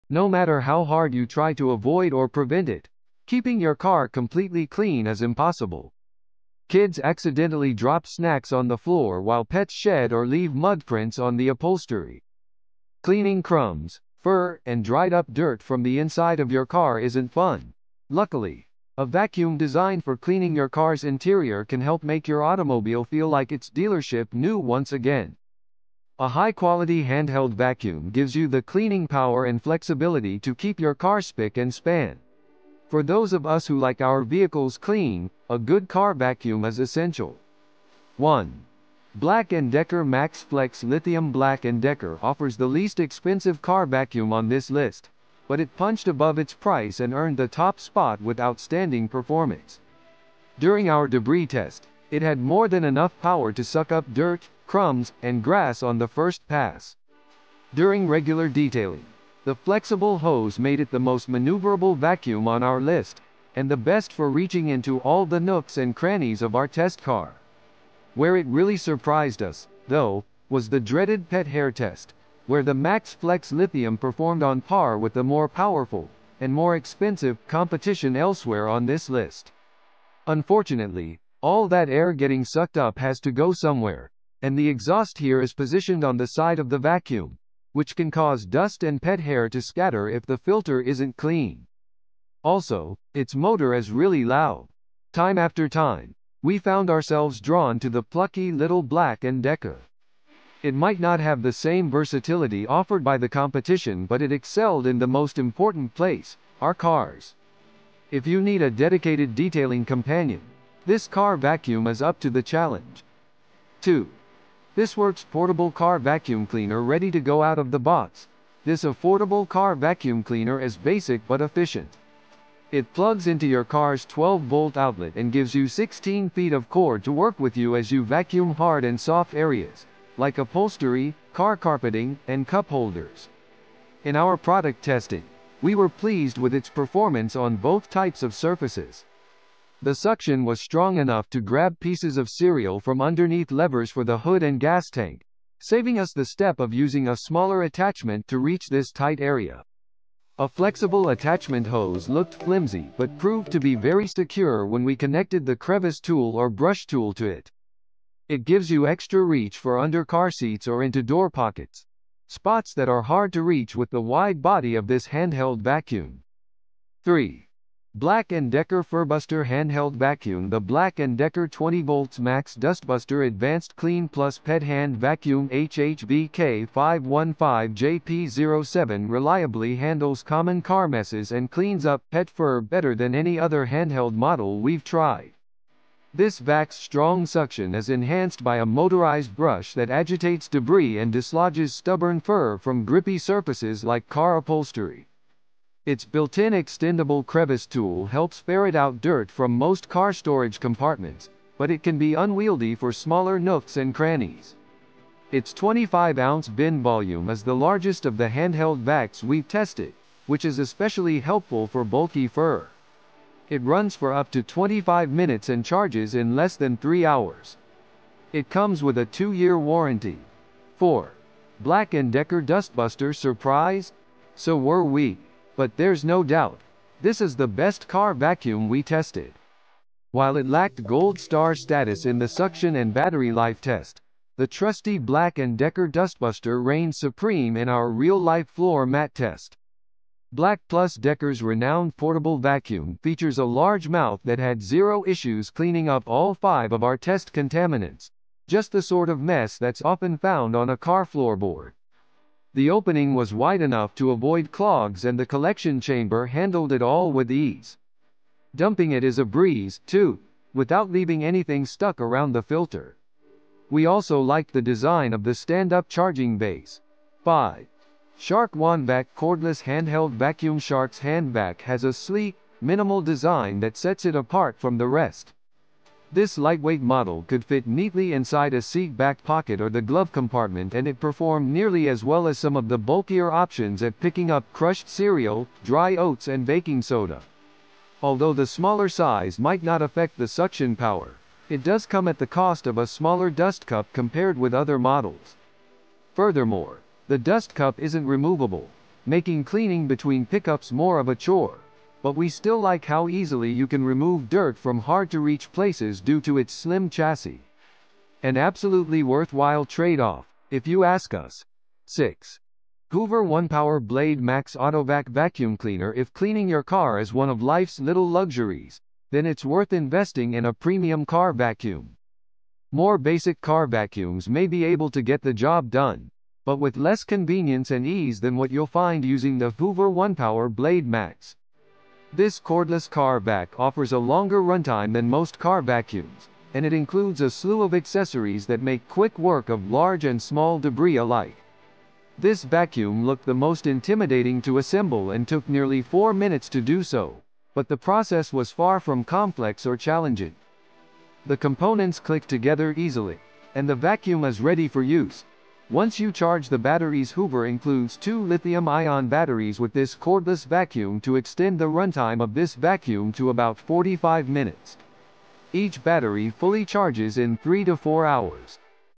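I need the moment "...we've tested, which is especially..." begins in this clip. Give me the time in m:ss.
3:29.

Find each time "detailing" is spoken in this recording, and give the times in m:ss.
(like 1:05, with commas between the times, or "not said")
0:58, 1:49.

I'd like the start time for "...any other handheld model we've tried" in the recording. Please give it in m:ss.
3:03.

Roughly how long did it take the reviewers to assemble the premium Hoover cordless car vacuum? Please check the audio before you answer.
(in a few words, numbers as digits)
nearly 4 minutes.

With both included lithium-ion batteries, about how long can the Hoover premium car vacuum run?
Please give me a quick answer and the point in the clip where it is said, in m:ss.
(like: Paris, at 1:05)
about 45 minutes, at 6:03.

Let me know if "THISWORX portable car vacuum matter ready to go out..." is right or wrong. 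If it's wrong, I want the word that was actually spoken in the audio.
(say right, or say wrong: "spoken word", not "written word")
wrong: "cleaner", not "matter".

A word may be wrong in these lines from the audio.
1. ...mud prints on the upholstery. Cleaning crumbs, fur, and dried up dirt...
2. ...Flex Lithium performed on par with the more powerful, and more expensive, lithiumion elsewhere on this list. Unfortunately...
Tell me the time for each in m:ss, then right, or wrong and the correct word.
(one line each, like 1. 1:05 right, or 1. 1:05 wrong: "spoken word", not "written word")
1. 0:10 right
2. 1:13 wrong: "competition", not "lithiumion".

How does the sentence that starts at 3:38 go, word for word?
It comes with a 2-year warranty.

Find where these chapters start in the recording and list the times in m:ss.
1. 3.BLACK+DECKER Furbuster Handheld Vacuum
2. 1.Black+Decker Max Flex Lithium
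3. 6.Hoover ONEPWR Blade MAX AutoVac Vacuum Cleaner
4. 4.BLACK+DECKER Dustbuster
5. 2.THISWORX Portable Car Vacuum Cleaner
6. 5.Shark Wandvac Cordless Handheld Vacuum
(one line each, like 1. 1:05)
1. 2:46
2. 0:38
3. 5:11
4. 3:40
5. 1:53
6. 4:27.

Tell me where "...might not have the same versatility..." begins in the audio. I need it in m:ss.
1:40.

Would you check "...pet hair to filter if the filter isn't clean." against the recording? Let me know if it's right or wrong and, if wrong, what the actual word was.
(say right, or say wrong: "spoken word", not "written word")
wrong: "scatter", not "filter".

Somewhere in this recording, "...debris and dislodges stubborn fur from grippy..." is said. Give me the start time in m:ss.
3:10.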